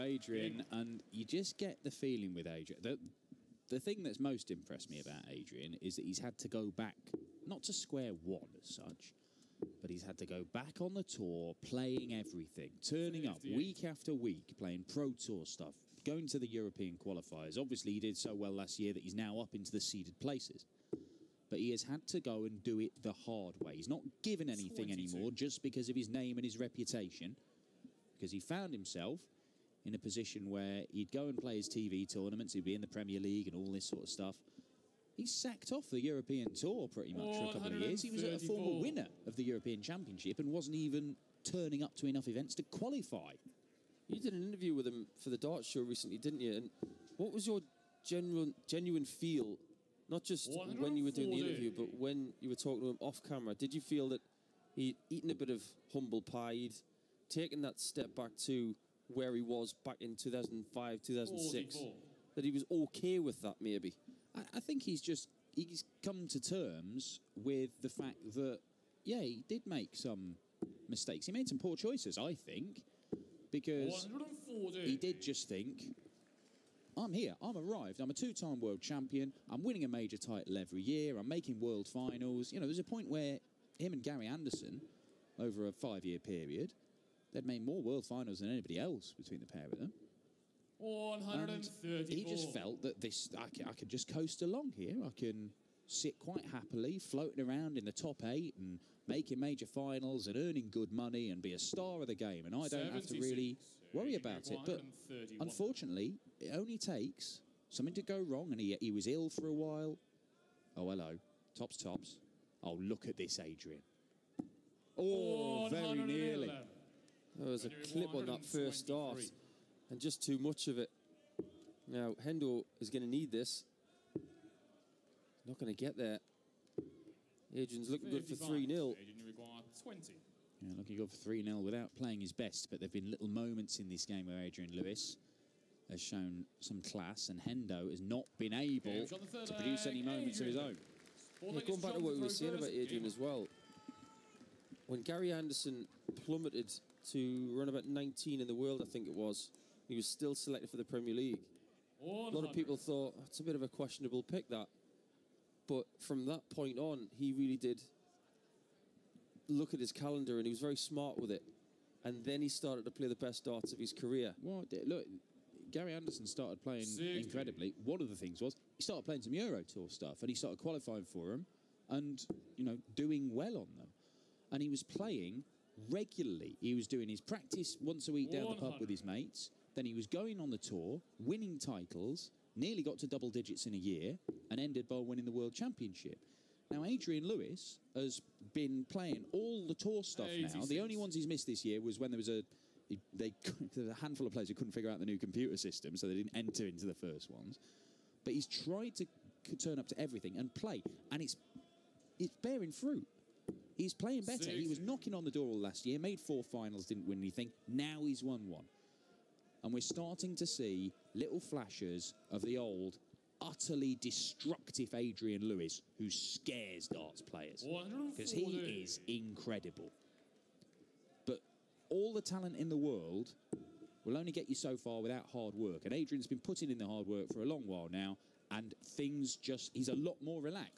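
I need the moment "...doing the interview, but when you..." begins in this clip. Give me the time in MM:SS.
00:51.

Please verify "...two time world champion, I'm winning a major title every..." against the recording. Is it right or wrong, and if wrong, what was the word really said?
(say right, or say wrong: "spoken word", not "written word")
right.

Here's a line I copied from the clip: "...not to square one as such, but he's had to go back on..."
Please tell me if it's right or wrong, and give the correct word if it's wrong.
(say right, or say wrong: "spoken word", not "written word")
right.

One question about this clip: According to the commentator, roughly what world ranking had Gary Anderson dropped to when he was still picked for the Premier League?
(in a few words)
19.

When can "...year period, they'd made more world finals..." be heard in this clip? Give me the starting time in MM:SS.
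01:26.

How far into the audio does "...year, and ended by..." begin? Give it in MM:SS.
03:03.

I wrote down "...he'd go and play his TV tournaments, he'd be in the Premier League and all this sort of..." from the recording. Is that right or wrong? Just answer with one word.
right.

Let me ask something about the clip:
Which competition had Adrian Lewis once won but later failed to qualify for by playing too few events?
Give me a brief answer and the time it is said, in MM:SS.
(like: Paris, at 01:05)
European Championship, at 00:39.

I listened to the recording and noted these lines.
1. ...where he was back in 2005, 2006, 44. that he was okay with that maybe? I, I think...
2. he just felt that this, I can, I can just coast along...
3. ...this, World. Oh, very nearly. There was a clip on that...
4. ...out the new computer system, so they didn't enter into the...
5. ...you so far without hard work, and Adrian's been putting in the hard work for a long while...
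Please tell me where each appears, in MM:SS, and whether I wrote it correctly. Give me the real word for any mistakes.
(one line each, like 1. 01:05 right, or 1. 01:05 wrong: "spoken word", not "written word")
1. 00:59 right
2. 01:32 right
3. 01:53 wrong: "Adrian", not "World"
4. 03:14 right
5. 03:44 right.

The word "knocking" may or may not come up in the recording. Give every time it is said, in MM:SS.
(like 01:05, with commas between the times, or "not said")
03:24.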